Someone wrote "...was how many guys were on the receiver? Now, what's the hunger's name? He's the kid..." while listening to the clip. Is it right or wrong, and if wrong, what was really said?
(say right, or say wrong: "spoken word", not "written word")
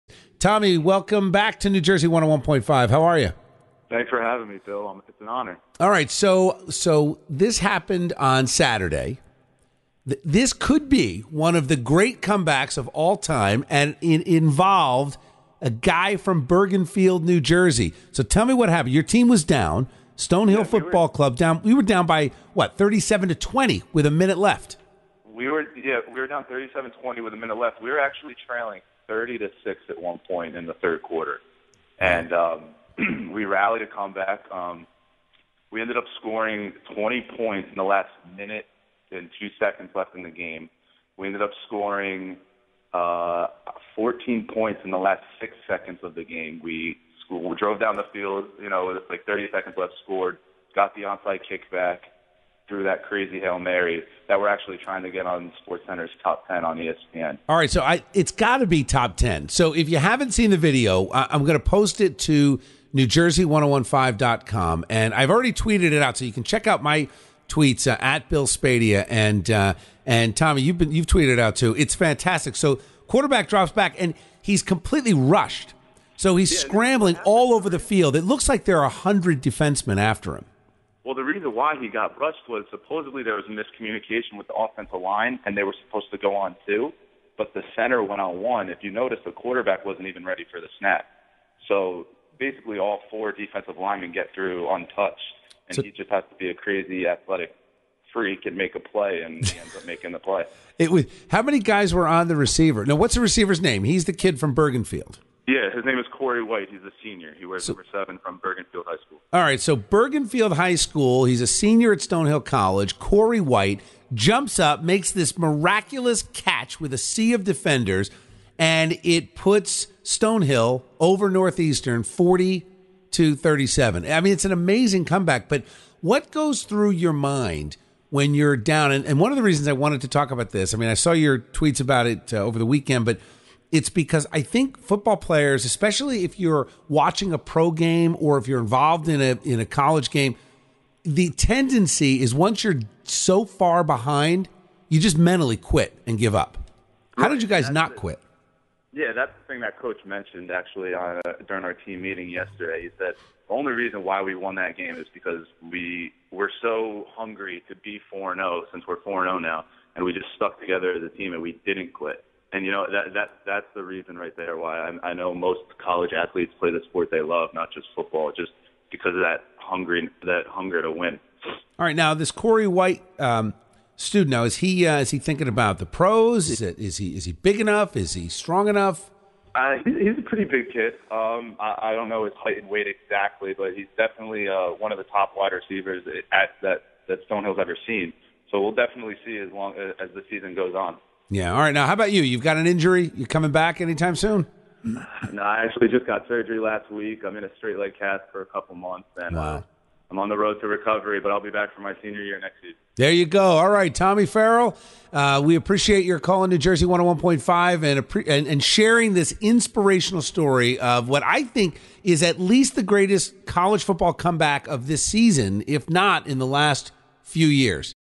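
wrong: "receiver", not "hunger".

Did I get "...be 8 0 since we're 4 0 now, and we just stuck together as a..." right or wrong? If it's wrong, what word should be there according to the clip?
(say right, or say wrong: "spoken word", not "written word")
wrong: "4", not "8".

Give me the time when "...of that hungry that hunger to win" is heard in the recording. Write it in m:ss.
2:49.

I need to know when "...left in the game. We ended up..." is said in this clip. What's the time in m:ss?
0:39.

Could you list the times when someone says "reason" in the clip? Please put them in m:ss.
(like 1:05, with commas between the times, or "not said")
1:21, 2:09, 2:33, 2:43.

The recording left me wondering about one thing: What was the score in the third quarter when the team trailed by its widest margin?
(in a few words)
30 to 6.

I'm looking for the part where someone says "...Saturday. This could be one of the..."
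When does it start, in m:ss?
0:08.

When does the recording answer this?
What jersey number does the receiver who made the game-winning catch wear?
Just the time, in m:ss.
1:47.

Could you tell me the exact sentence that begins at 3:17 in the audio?
I'm in a straight leg cast for a couple months, and uh, wow.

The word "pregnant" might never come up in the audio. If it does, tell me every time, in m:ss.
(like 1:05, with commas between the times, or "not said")
not said.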